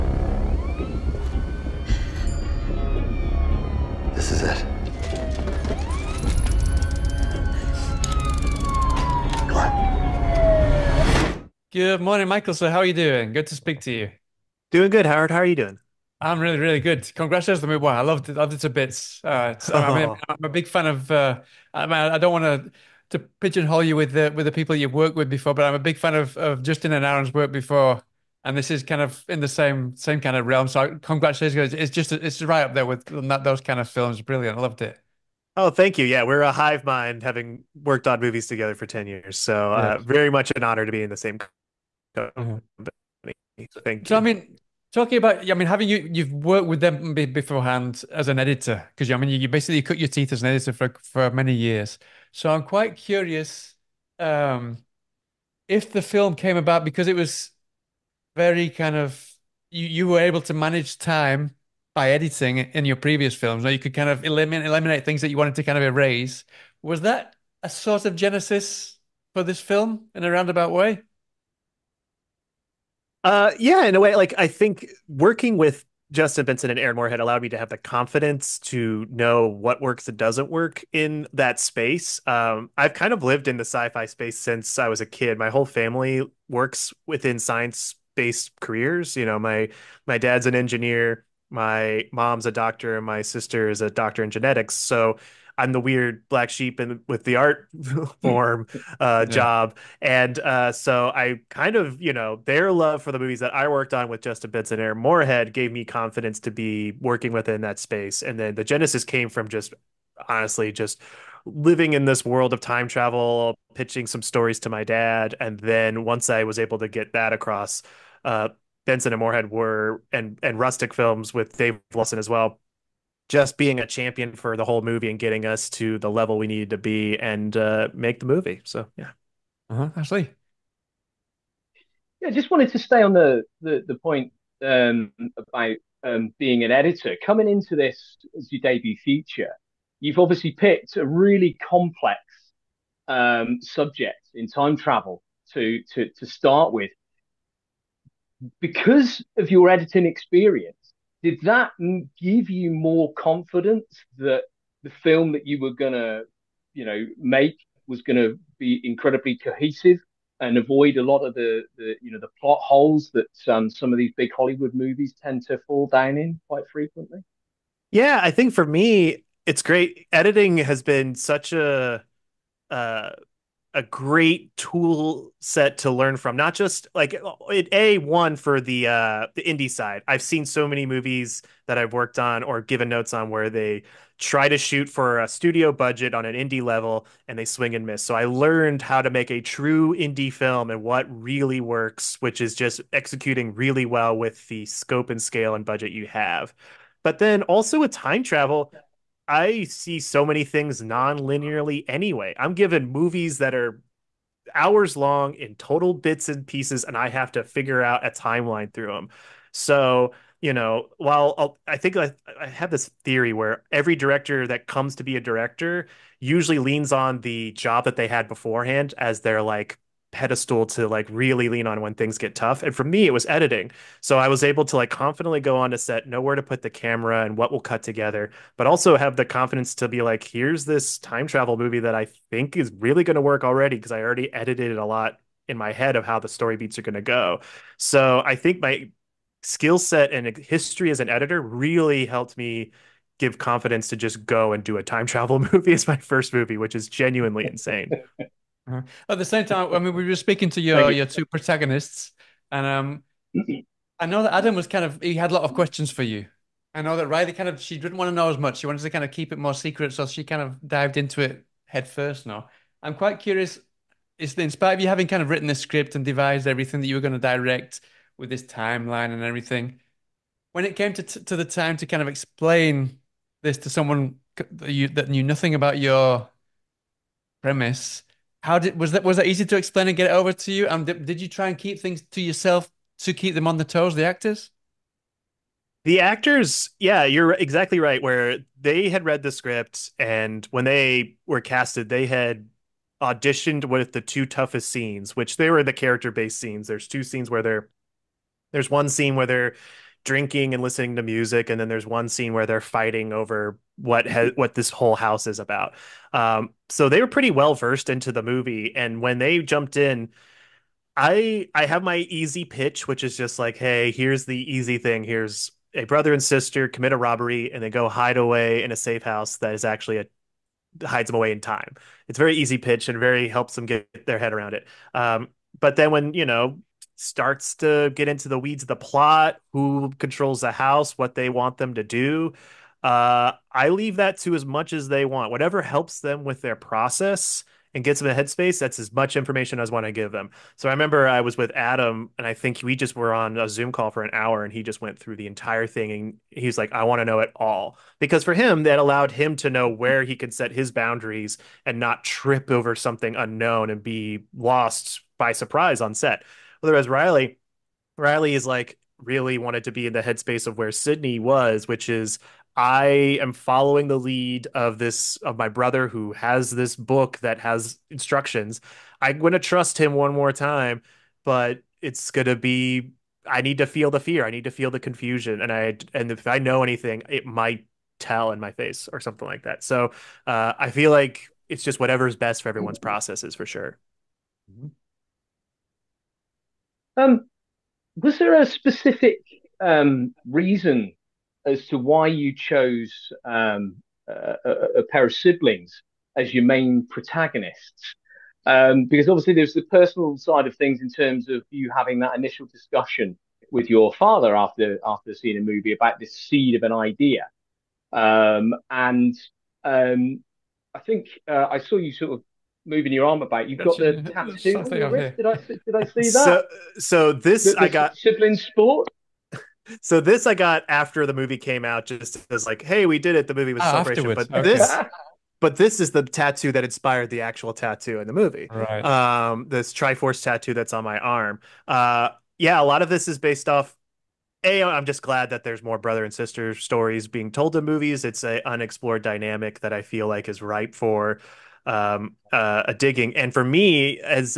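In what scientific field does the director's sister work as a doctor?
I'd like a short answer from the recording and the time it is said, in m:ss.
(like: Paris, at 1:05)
Genetics, at 1:34.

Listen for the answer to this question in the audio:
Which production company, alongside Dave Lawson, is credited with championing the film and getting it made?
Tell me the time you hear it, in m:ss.
2:00.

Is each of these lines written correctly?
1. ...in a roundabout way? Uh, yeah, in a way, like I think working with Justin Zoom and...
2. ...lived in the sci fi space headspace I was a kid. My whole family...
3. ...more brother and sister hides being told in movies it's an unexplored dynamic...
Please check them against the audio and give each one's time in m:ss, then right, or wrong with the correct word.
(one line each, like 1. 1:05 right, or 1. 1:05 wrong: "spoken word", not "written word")
1. 1:10 wrong: "Benson", not "Zoom"
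2. 1:23 wrong: "since", not "headspace"
3. 7:15 wrong: "stories", not "hides".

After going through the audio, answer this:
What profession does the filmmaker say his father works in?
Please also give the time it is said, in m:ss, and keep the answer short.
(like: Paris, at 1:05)
Engineer, at 1:30.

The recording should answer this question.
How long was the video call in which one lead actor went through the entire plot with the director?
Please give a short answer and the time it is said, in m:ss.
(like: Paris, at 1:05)
An hour, at 5:44.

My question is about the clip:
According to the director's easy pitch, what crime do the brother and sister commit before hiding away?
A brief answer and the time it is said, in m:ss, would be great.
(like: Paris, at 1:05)
A robbery, at 5:16.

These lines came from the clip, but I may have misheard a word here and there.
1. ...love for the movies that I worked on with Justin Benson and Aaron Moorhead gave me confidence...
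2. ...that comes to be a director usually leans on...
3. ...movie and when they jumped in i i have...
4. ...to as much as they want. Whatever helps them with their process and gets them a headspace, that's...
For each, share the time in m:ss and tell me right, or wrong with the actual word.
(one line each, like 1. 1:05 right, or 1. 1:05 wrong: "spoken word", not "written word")
1. 1:42 right
2. 3:34 right
3. 5:08 right
4. 5:34 right.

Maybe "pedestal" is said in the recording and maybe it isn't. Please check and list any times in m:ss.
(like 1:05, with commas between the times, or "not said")
3:40.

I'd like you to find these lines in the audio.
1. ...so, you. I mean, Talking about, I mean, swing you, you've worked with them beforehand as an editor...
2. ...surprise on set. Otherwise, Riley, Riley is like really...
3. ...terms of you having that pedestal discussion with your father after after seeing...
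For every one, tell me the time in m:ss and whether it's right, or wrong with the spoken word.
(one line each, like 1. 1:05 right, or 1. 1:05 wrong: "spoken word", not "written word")
1. 0:44 wrong: "having", not "swing"
2. 5:55 right
3. 6:40 wrong: "initial", not "pedestal".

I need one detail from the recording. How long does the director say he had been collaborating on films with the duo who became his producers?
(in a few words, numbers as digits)
10 years.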